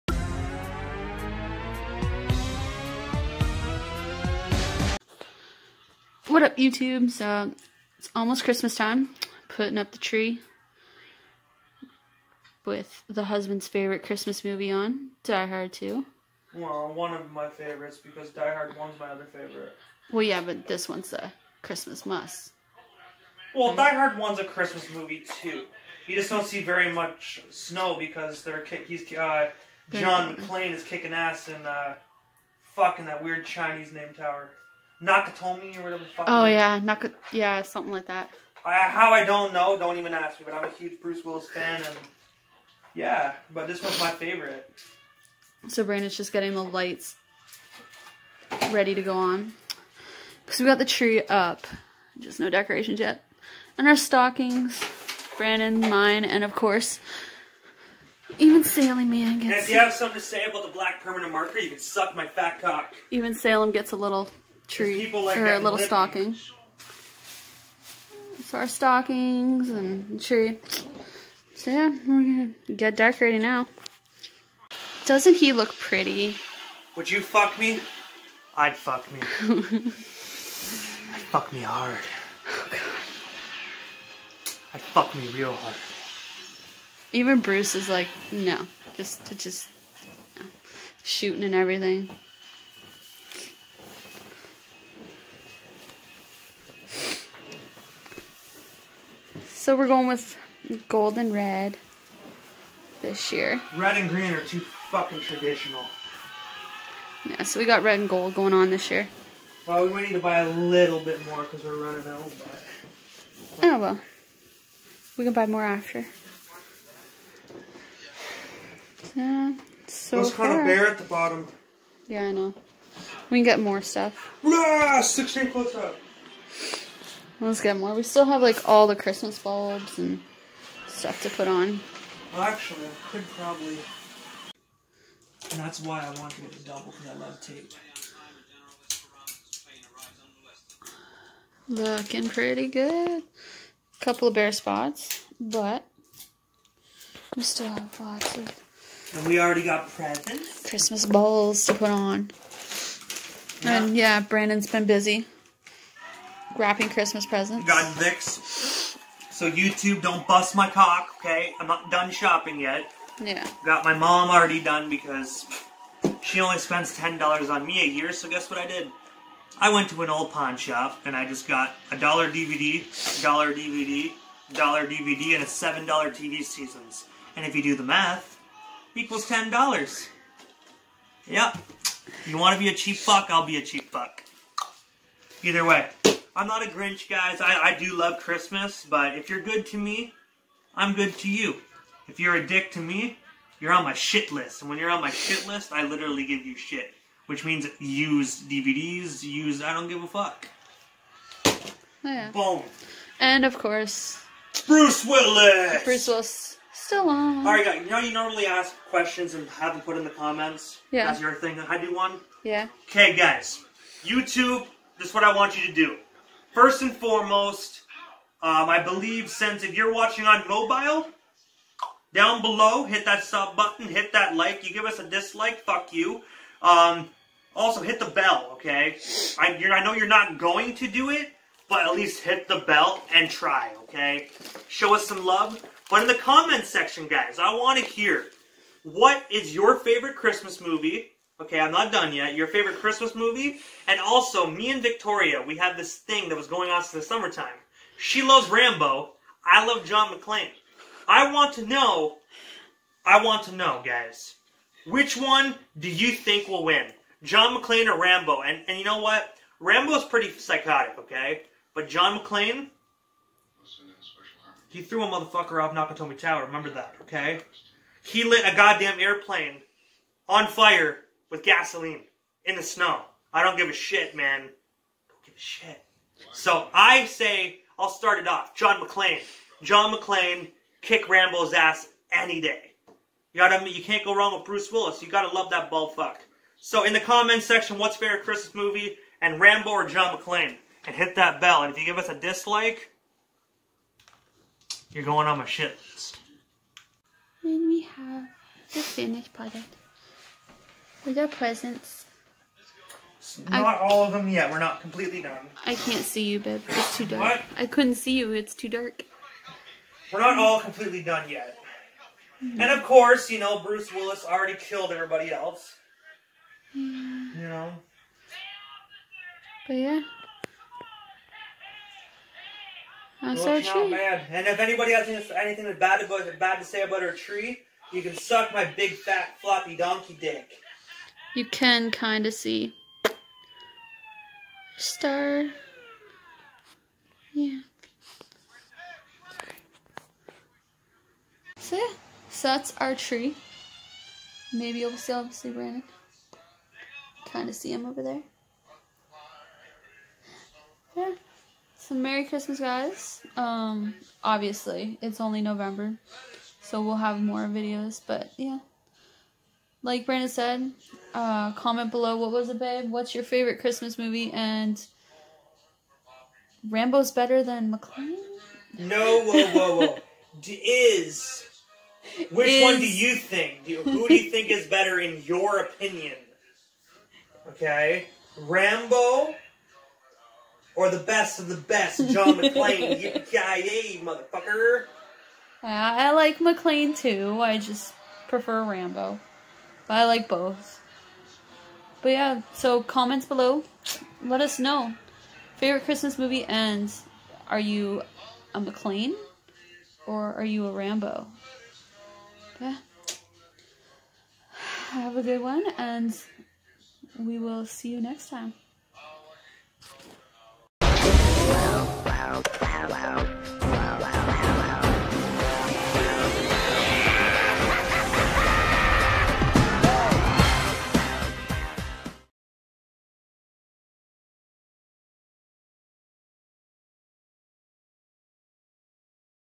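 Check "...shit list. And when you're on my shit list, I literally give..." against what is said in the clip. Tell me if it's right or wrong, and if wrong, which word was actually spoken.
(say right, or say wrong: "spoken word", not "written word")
right.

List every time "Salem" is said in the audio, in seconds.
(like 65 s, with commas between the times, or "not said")
58 s, 63 s.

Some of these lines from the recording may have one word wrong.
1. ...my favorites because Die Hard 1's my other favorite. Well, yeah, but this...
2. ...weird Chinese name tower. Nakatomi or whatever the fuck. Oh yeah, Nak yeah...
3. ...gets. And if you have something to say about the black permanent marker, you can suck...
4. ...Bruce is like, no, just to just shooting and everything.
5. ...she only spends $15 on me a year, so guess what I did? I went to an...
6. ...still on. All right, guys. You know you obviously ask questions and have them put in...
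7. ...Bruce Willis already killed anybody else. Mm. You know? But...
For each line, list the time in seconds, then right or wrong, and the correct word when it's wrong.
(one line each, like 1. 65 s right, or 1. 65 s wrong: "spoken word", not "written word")
1. 17 s right
2. 33 s right
3. 59 s right
4. 87 s right
5. 166 s wrong: "10", not "15"
6. 206 s wrong: "normally", not "obviously"
7. 313 s wrong: "everybody", not "anybody".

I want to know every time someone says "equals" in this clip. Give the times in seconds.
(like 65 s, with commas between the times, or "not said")
178 s.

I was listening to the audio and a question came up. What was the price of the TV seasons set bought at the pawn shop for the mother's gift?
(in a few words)
$7.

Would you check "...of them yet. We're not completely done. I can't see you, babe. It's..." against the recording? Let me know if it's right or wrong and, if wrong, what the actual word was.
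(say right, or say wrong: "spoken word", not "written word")
right.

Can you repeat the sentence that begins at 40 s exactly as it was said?
But I'm a huge Bruce Willis fan, and yeah, but this one's my favorite.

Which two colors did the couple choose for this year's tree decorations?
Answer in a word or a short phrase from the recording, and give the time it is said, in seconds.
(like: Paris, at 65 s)
Gold and red, at 100 s.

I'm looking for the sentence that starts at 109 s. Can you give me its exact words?
Well, we might need to buy a little bit more because we're running out, but...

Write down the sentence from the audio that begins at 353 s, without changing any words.
Um, obviously, it's only November, so we'll have more videos.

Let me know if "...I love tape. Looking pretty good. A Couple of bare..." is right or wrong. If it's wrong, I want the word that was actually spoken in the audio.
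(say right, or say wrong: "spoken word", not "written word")
right.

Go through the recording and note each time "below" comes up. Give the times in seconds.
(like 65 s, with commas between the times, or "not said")
222 s, 361 s, 393 s.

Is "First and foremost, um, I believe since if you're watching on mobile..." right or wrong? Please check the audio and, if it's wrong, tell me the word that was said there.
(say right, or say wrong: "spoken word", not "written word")
right.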